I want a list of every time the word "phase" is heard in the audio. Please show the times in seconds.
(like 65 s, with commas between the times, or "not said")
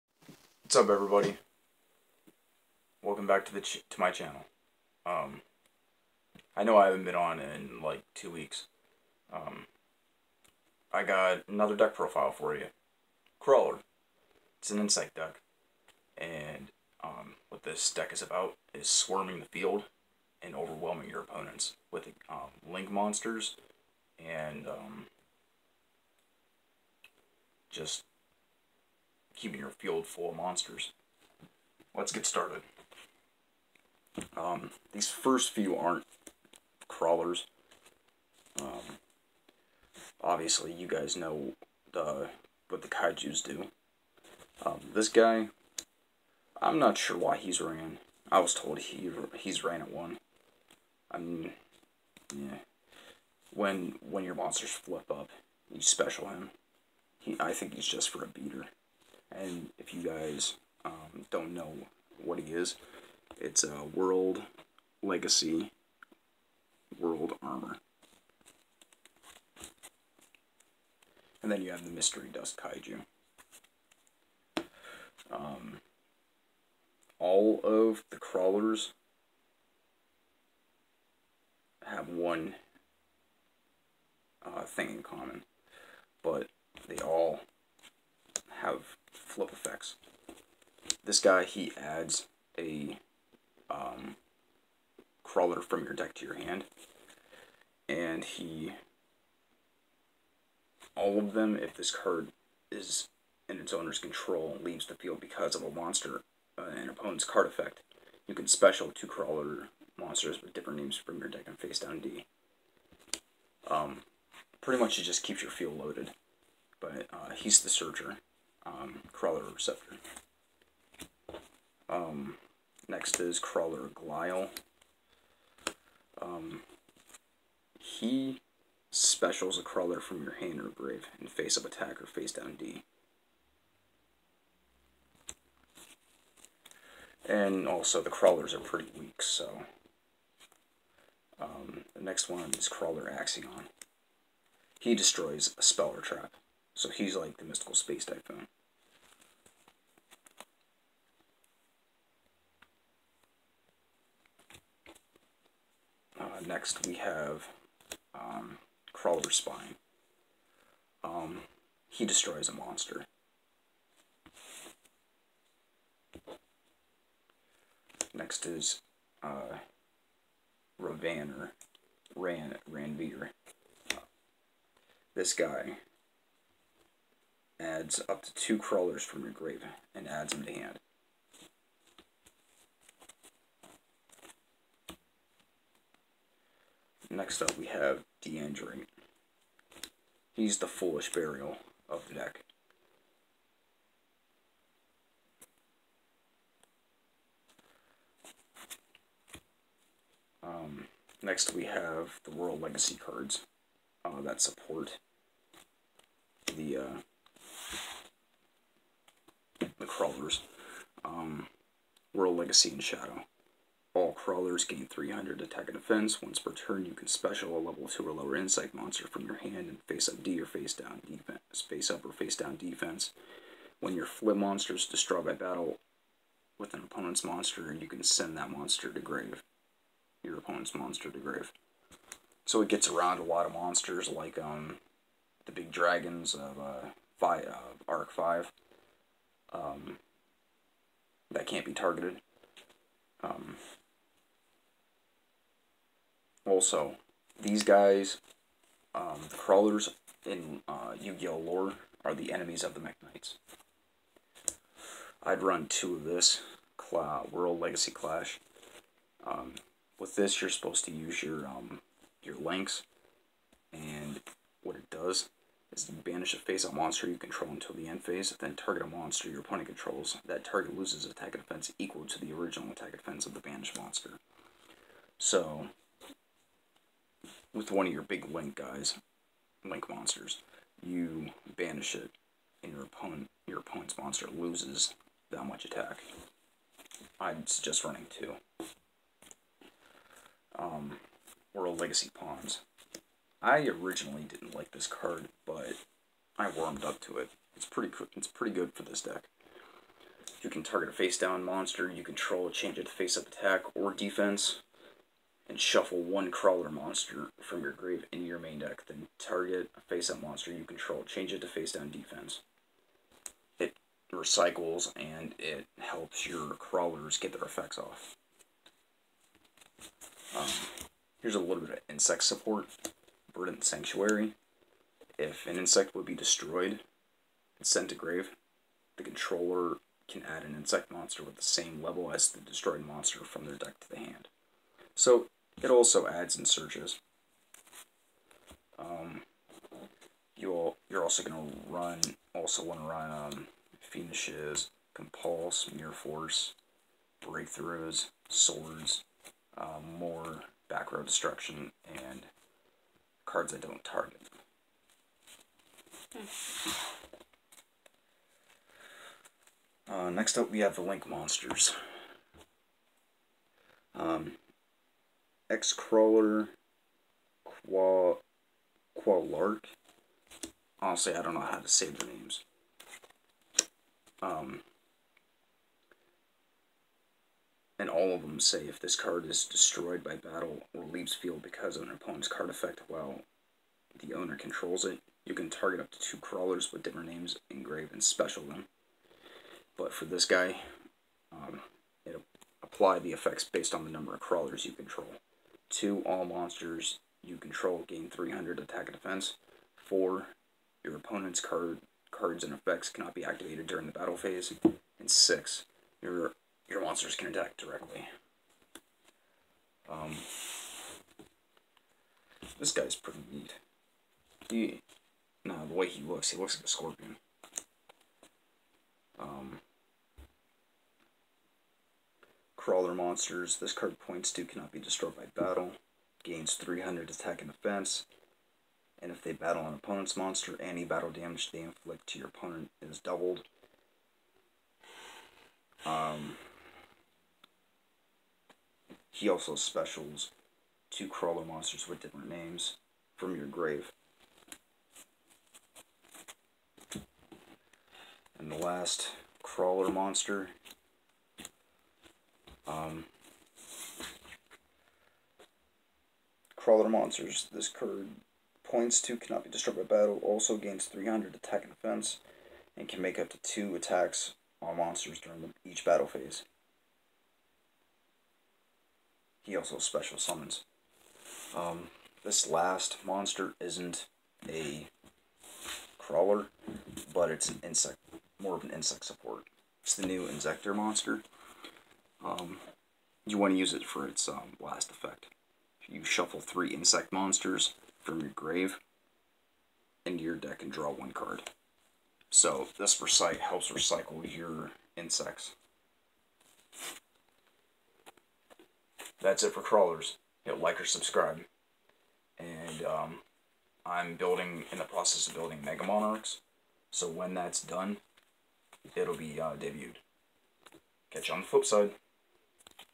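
268 s, 404 s, 466 s.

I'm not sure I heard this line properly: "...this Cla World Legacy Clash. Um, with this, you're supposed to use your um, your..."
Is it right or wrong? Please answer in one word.
right.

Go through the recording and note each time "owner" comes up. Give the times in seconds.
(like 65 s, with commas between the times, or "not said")
103 s, 384 s.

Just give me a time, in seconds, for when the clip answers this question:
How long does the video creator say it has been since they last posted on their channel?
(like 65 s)
8 s.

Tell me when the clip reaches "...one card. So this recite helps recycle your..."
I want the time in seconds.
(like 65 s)
490 s.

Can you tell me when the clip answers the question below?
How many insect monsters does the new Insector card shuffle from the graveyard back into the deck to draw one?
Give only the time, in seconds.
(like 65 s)
486 s.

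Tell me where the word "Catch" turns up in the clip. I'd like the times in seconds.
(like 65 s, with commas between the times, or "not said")
511 s.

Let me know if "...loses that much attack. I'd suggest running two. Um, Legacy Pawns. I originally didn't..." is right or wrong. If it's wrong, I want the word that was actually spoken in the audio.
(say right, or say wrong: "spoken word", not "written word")
right.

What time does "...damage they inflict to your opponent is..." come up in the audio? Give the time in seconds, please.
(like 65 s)
431 s.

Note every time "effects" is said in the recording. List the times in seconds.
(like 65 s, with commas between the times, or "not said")
89 s, 107 s, 317 s, 382 s, 393 s, 402 s, 484 s.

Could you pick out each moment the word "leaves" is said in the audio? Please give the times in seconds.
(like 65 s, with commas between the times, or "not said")
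104 s, 380 s.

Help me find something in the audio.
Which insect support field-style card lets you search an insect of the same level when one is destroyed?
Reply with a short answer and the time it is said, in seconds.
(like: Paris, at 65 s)
Verdant Sanctuary, at 323 s.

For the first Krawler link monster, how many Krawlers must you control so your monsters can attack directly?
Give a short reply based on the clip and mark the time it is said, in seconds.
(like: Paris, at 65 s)
6, at 405 s.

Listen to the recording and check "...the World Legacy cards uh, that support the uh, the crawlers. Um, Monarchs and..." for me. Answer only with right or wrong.
wrong.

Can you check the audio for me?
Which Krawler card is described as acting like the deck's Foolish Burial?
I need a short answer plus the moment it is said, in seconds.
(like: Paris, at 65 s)
Dendrite, at 188 s.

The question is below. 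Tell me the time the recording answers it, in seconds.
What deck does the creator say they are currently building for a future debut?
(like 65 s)
505 s.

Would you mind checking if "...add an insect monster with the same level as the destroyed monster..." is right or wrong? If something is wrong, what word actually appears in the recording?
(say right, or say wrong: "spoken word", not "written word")
right.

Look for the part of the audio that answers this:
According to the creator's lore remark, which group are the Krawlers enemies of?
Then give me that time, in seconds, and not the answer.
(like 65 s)
252 s.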